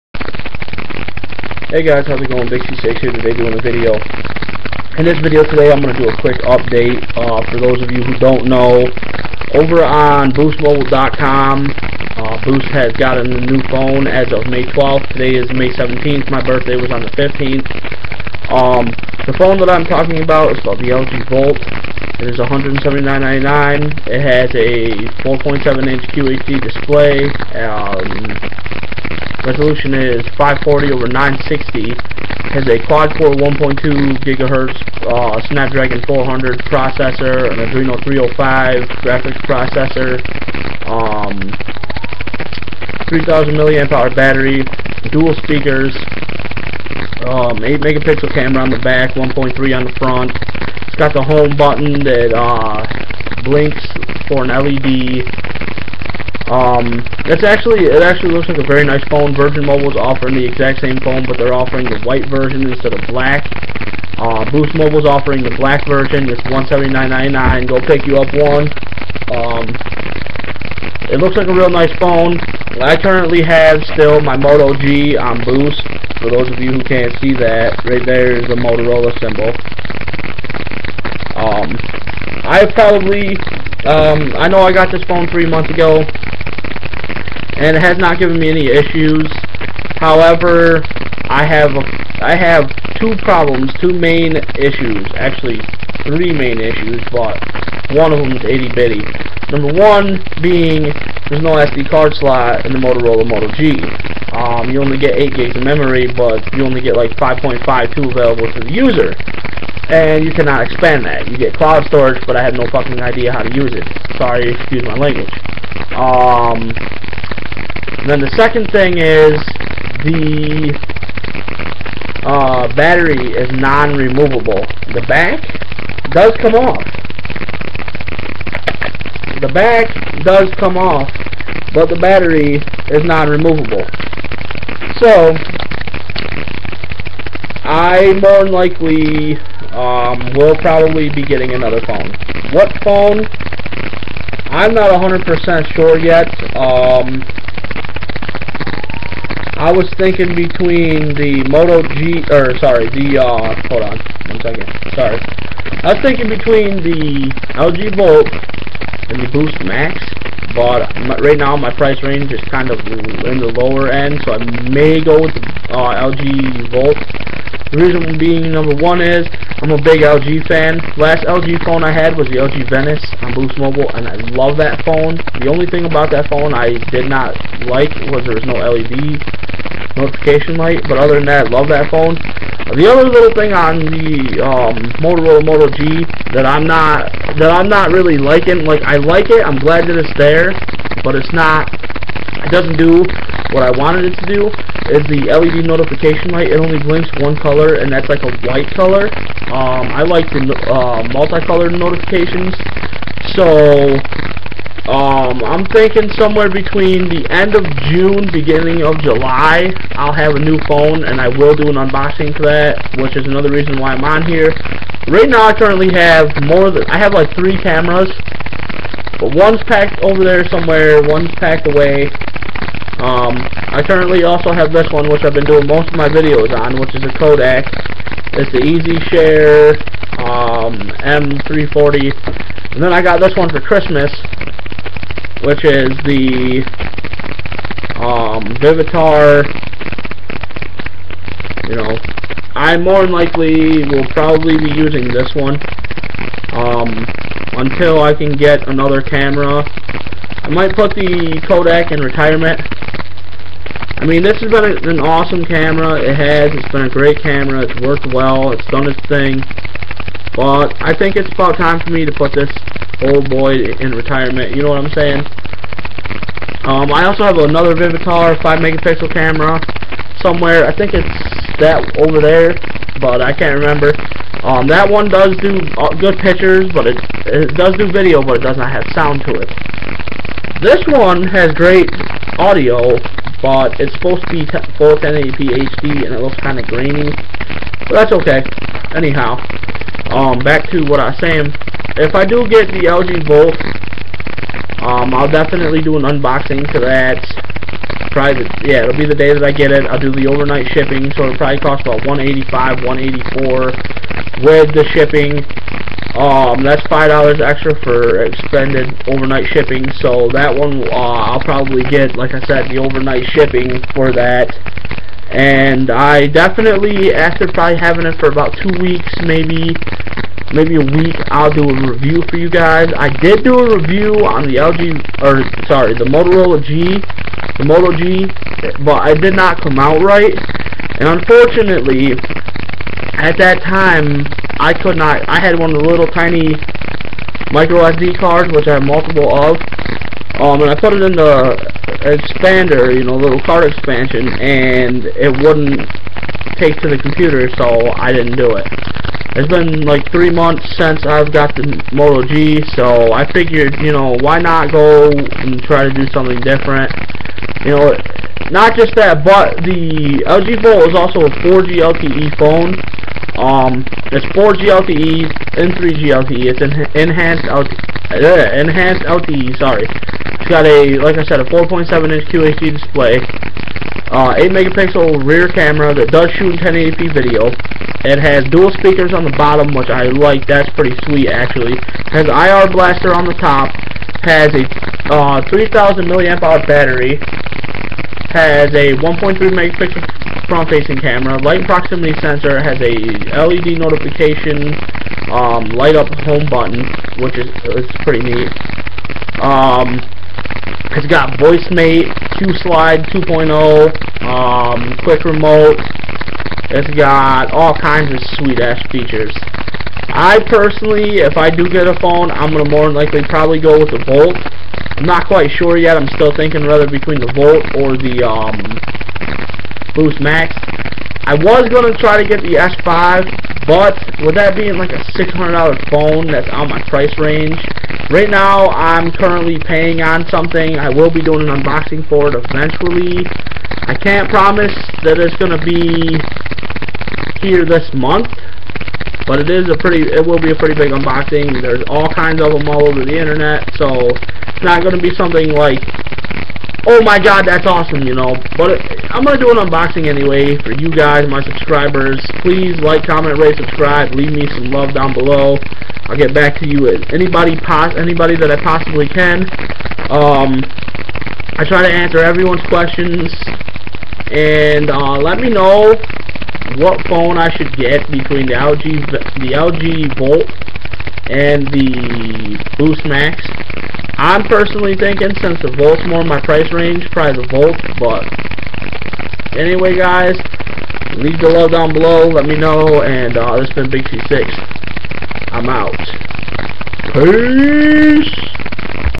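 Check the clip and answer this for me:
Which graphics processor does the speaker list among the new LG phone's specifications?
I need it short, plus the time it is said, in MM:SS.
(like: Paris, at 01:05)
Adreno 305, at 00:37.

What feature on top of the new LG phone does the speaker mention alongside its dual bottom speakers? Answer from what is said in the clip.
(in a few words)
IR blaster.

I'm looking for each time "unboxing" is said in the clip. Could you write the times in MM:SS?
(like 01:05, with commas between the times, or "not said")
03:31, 04:56, 07:11, 07:20, 07:29.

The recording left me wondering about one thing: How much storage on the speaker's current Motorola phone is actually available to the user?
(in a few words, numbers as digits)
5.52 GB.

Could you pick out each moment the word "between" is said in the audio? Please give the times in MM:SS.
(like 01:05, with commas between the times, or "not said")
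02:30, 02:36, 03:26, 06:56, 07:48.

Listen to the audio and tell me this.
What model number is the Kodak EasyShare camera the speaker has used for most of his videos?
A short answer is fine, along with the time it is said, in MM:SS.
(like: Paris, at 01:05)
M340, at 03:51.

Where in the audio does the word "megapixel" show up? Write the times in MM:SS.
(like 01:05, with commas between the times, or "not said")
00:47, 04:28, 06:14, 06:29.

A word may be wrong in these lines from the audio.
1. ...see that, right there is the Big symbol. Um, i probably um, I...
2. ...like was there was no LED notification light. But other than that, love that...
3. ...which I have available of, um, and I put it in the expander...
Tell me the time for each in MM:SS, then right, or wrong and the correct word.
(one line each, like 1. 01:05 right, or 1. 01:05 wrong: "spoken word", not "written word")
1. 01:17 wrong: "Motorola", not "Big"
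2. 02:57 right
3. 05:38 wrong: "multiple", not "available".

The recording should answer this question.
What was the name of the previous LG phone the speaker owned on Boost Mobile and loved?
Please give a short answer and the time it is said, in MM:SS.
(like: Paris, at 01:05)
LG Venice, at 02:52.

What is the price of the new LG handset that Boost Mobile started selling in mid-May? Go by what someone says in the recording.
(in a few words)
$179.99.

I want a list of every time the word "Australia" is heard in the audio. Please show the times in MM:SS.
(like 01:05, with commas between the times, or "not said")
not said.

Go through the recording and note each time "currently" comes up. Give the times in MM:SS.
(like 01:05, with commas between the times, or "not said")
01:12, 03:35, 03:43, 07:09.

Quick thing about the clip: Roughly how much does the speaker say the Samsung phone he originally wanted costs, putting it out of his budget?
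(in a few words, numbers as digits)
$600.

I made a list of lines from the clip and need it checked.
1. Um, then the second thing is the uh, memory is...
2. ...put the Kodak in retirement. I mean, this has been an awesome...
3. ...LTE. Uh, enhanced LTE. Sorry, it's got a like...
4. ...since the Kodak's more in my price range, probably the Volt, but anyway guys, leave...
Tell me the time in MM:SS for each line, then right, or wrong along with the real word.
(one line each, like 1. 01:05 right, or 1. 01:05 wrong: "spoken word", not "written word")
1. 01:55 wrong: "battery", not "memory"
2. 04:10 right
3. 06:07 right
4. 07:55 wrong: "Volt", not "Kodak".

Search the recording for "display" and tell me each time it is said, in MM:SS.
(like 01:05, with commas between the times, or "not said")
00:26, 06:12.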